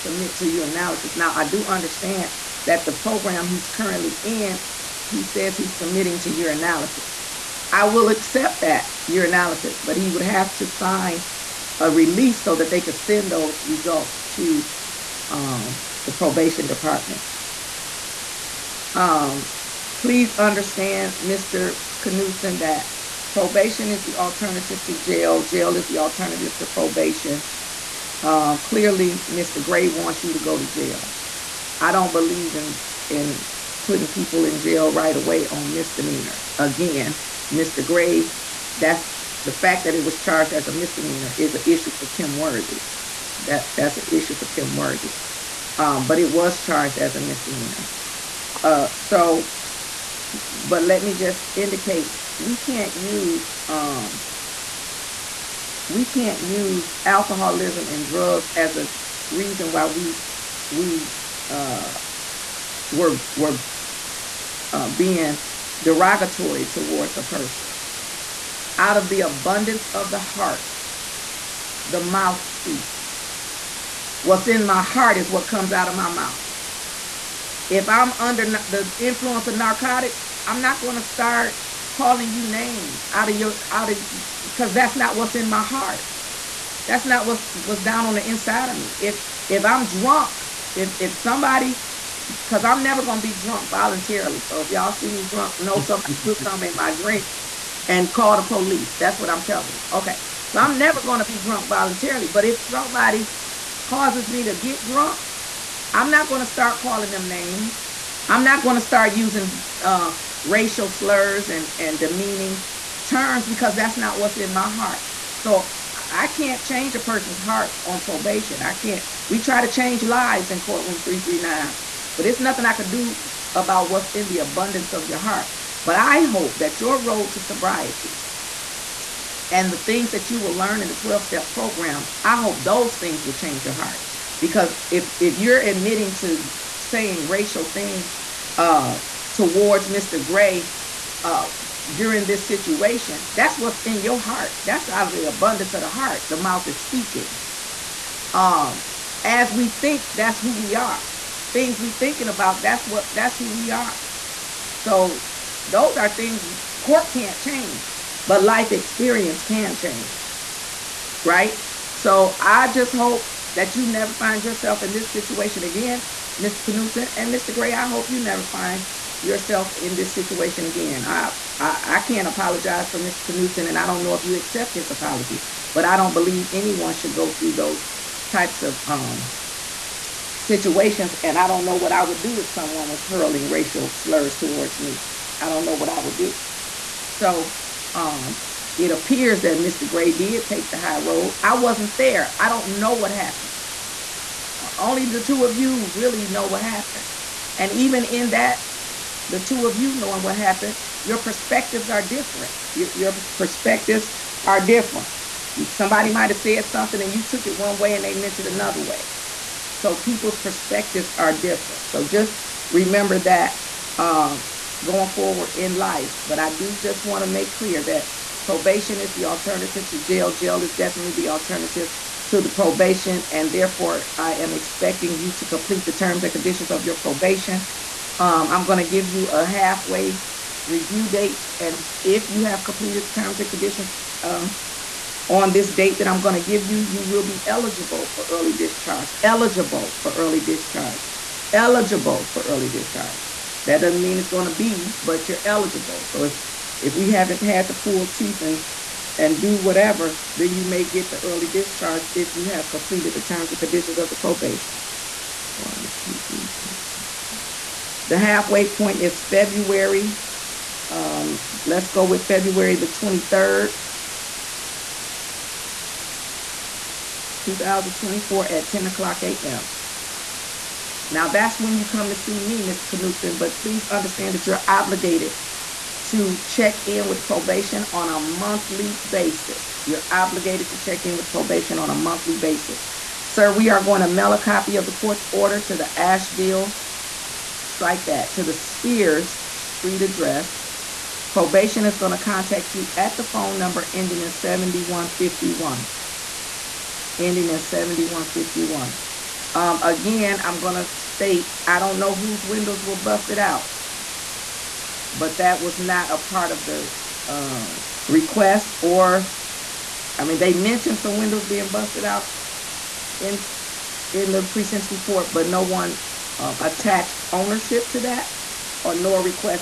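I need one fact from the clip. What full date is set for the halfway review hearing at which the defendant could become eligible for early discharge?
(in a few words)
February 23, 2024.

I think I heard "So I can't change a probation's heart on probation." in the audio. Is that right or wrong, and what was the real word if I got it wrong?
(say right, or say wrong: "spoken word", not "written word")
wrong: "person", not "probation".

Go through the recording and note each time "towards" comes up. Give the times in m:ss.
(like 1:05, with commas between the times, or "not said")
1:06, 2:19, 3:04.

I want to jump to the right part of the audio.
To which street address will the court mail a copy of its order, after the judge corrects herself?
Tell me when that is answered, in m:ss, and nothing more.
4:48.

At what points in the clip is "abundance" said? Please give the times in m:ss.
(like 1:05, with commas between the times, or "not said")
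1:09, 2:04, 2:25.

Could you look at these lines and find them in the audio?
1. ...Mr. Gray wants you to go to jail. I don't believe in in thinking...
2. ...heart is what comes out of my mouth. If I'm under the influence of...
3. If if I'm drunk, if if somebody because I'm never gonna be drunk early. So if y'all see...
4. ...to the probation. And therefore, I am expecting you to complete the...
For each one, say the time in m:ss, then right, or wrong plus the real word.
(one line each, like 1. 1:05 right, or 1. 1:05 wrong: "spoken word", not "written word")
1. 0:29 wrong: "putting", not "thinking"
2. 1:14 right
3. 1:29 wrong: "voluntarily", not "early"
4. 3:42 right.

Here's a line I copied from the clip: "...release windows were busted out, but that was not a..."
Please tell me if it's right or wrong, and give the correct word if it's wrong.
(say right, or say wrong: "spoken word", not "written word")
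wrong: "whose", not "release".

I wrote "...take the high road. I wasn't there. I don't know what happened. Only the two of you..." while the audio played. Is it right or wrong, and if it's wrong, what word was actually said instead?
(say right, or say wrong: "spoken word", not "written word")
right.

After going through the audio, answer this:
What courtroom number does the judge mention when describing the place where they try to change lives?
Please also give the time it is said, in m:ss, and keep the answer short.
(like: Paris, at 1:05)
339, at 2:01.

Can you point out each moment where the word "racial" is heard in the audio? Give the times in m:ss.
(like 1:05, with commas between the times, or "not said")
1:50, 2:17, 3:03.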